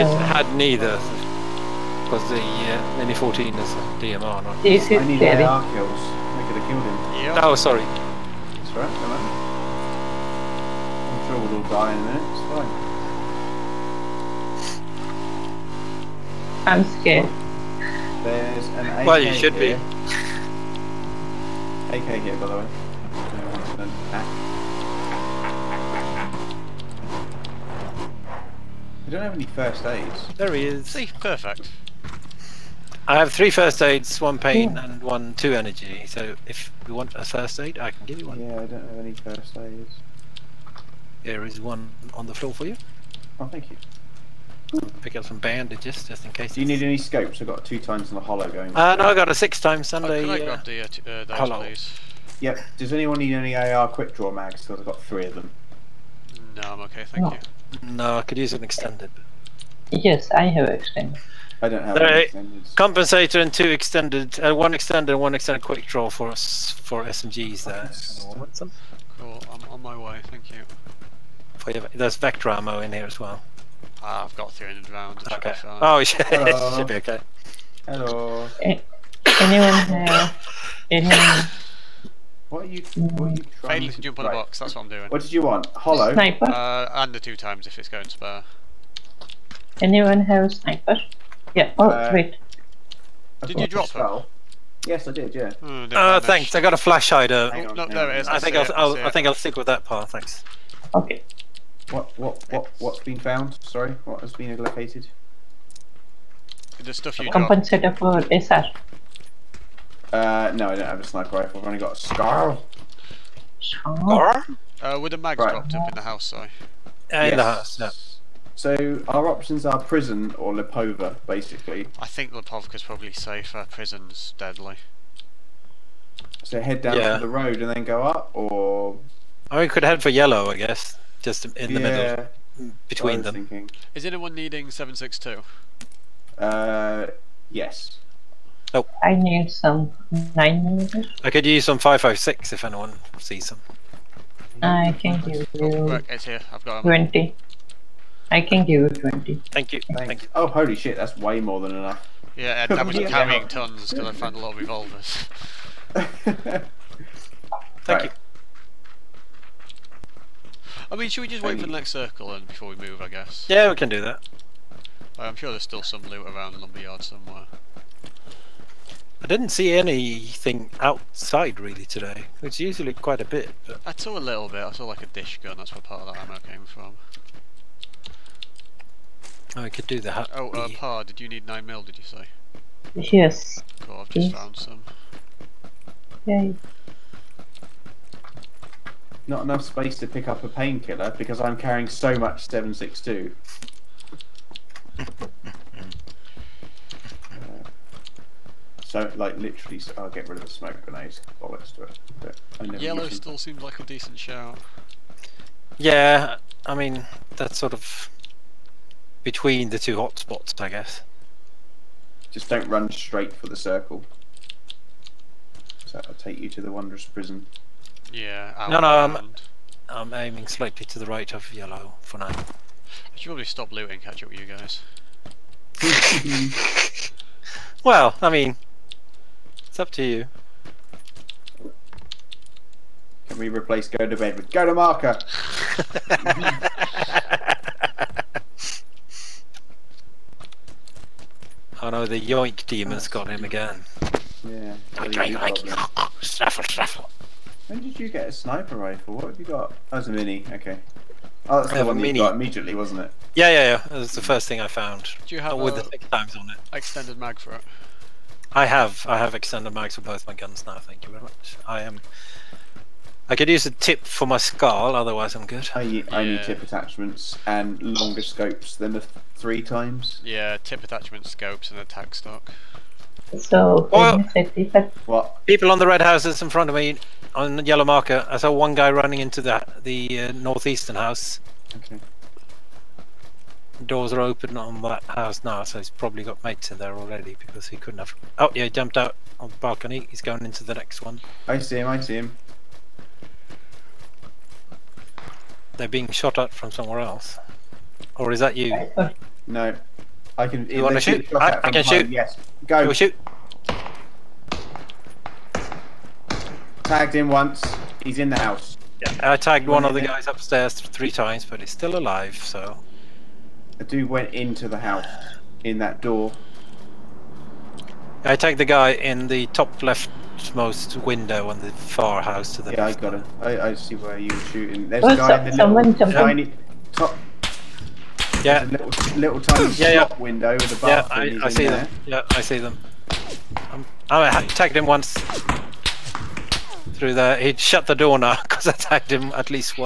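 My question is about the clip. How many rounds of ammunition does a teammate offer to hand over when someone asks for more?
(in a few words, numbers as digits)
20.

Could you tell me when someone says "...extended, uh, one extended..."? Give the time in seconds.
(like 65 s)
63 s.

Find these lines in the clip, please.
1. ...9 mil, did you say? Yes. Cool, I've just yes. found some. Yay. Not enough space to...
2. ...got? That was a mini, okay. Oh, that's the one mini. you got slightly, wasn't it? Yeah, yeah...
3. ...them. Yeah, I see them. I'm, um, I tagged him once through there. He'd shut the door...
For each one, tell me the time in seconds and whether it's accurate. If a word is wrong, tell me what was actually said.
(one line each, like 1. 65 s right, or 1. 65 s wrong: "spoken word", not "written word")
1. 181 s right
2. 249 s wrong: "immediately", not "slightly"
3. 331 s right.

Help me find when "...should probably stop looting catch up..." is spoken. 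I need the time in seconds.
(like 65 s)
223 s.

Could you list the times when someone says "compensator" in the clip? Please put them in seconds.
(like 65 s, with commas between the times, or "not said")
62 s, 107 s.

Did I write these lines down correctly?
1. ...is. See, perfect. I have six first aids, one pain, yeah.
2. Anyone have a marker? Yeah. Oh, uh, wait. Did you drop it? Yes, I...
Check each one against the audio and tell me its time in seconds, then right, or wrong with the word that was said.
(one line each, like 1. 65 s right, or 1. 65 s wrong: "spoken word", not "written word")
1. 30 s wrong: "three", not "six"
2. 89 s wrong: "sniper", not "marker".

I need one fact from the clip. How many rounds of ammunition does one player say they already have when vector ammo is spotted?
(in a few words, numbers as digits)
300.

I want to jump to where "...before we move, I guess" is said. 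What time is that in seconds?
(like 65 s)
162 s.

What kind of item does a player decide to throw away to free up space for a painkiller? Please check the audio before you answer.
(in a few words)
Smoke grenades.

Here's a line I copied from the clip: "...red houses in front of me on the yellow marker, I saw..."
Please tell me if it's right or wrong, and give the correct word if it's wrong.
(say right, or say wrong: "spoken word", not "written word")
right.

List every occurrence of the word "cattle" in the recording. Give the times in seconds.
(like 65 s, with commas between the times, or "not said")
not said.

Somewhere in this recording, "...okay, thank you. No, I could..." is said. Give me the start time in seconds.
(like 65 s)
56 s.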